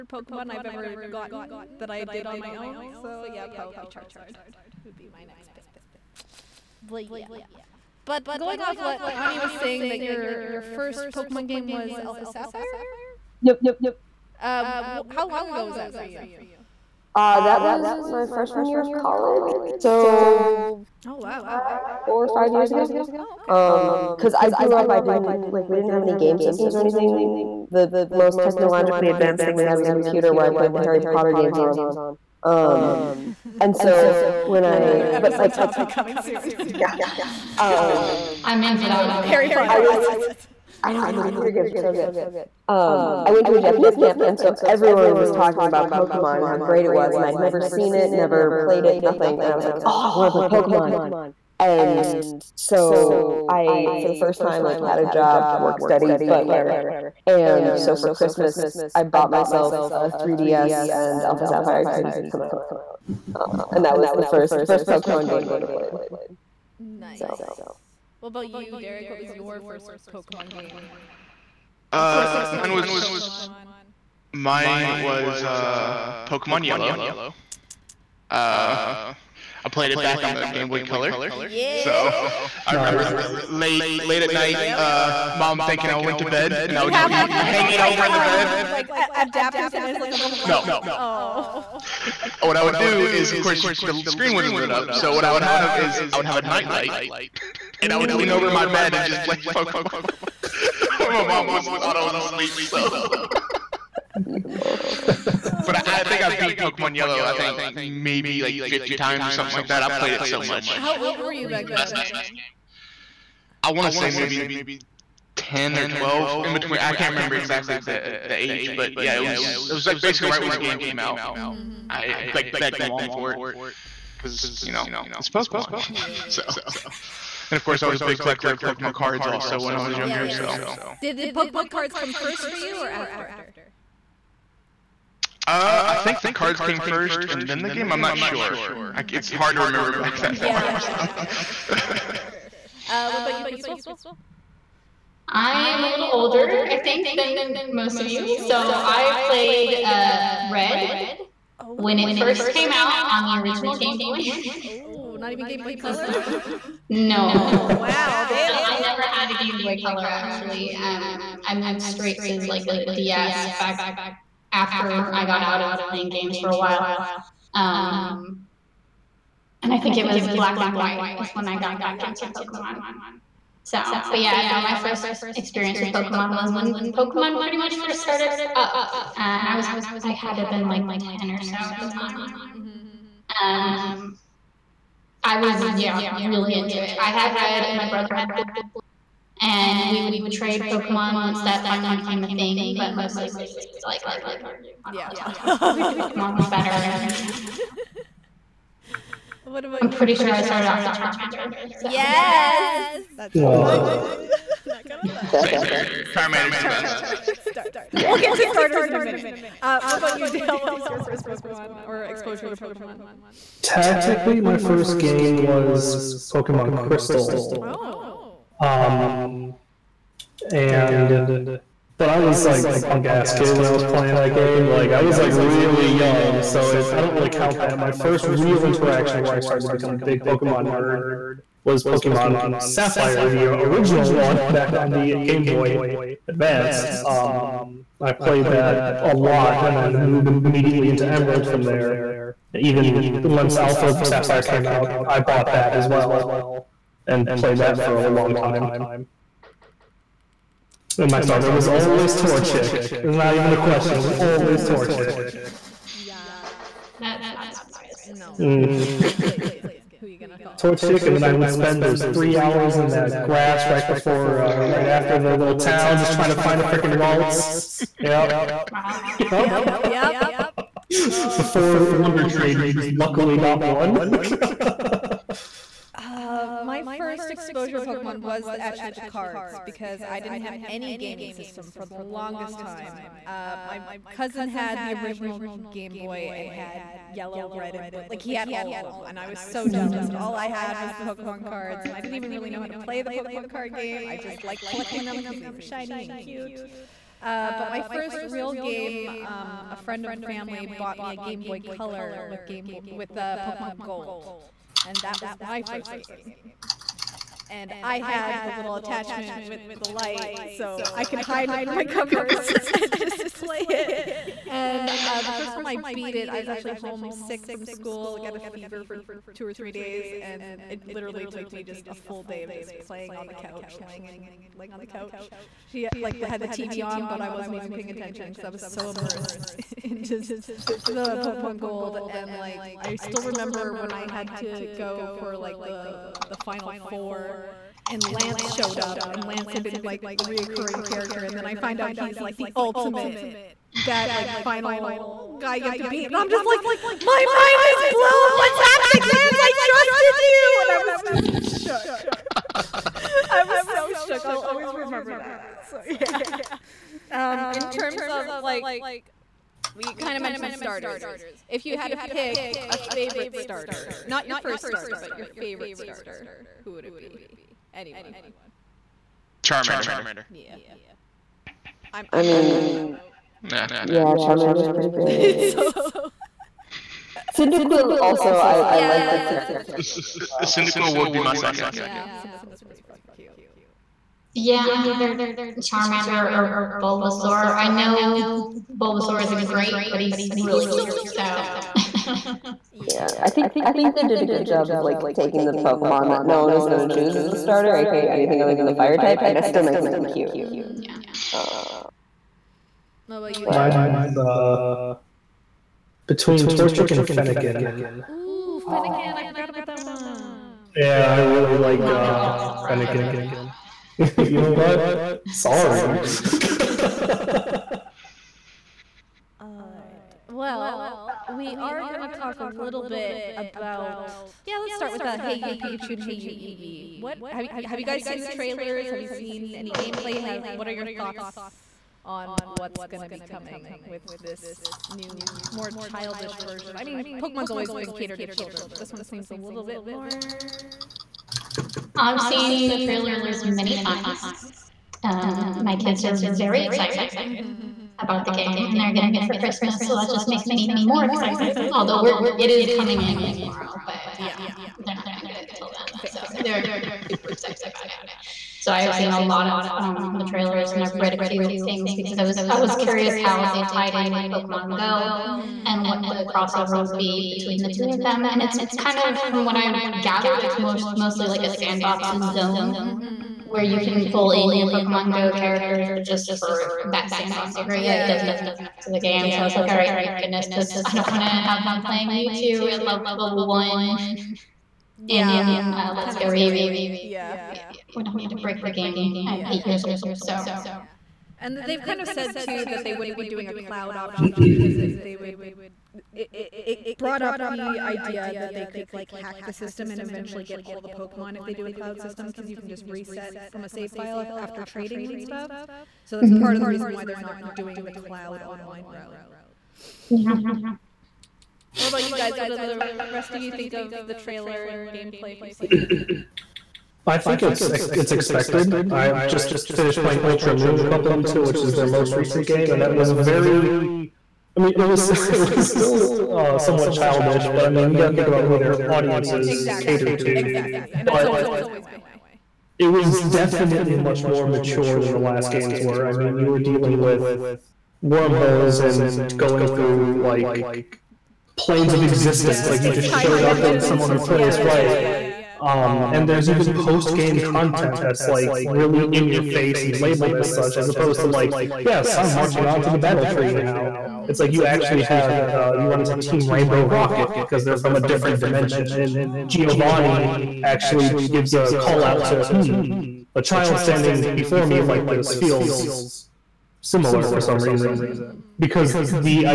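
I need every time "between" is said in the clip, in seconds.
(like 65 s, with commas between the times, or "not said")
116 s, 406 s, 467 s.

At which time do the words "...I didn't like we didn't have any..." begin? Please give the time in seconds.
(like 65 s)
24 s.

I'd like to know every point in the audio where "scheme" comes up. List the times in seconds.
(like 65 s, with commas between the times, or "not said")
not said.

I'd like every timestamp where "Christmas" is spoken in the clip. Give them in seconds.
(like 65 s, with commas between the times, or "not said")
58 s, 449 s.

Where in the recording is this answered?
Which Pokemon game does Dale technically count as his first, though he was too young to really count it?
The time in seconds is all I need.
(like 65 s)
216 s.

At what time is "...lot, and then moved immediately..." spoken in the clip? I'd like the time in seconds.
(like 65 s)
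239 s.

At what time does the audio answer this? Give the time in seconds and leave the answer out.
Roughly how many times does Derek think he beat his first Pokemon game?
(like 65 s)
108 s.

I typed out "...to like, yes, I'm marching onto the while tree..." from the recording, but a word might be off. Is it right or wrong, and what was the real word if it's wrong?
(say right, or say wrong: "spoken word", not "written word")
wrong: "battle", not "while".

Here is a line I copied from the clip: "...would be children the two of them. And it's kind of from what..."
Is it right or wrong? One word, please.
wrong.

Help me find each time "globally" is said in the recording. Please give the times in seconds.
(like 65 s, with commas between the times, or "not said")
not said.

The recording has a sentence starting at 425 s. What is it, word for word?
Uh, hey, you Pikachu and Hey, you Eevee.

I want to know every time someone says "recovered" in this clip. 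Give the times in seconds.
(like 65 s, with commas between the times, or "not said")
not said.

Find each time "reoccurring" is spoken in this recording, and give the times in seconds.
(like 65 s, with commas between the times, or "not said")
340 s.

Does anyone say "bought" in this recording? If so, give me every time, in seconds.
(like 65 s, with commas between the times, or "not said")
59 s, 245 s, 300 s.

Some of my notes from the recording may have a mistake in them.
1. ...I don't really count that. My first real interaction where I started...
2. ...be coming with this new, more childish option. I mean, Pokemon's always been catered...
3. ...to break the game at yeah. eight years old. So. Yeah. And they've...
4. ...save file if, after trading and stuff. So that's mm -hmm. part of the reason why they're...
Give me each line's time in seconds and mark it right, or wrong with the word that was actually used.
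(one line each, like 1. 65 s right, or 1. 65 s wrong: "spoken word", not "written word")
1. 226 s right
2. 433 s wrong: "version", not "option"
3. 488 s right
4. 503 s right.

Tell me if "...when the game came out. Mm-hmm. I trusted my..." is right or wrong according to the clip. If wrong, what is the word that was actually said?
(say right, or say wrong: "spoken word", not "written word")
wrong: "begged", not "trusted".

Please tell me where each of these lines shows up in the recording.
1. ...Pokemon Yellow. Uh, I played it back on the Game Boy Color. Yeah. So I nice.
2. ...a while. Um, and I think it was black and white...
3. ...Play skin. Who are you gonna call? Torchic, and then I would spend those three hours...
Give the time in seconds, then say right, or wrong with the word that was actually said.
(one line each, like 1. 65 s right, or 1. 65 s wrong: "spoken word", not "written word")
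1. 76 s right
2. 166 s right
3. 259 s right.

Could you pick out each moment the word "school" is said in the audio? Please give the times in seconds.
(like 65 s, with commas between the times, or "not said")
317 s.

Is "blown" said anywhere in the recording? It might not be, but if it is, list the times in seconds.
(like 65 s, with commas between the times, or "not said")
347 s.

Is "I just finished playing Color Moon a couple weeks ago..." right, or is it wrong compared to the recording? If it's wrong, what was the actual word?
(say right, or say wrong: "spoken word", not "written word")
wrong: "Ultra", not "Color".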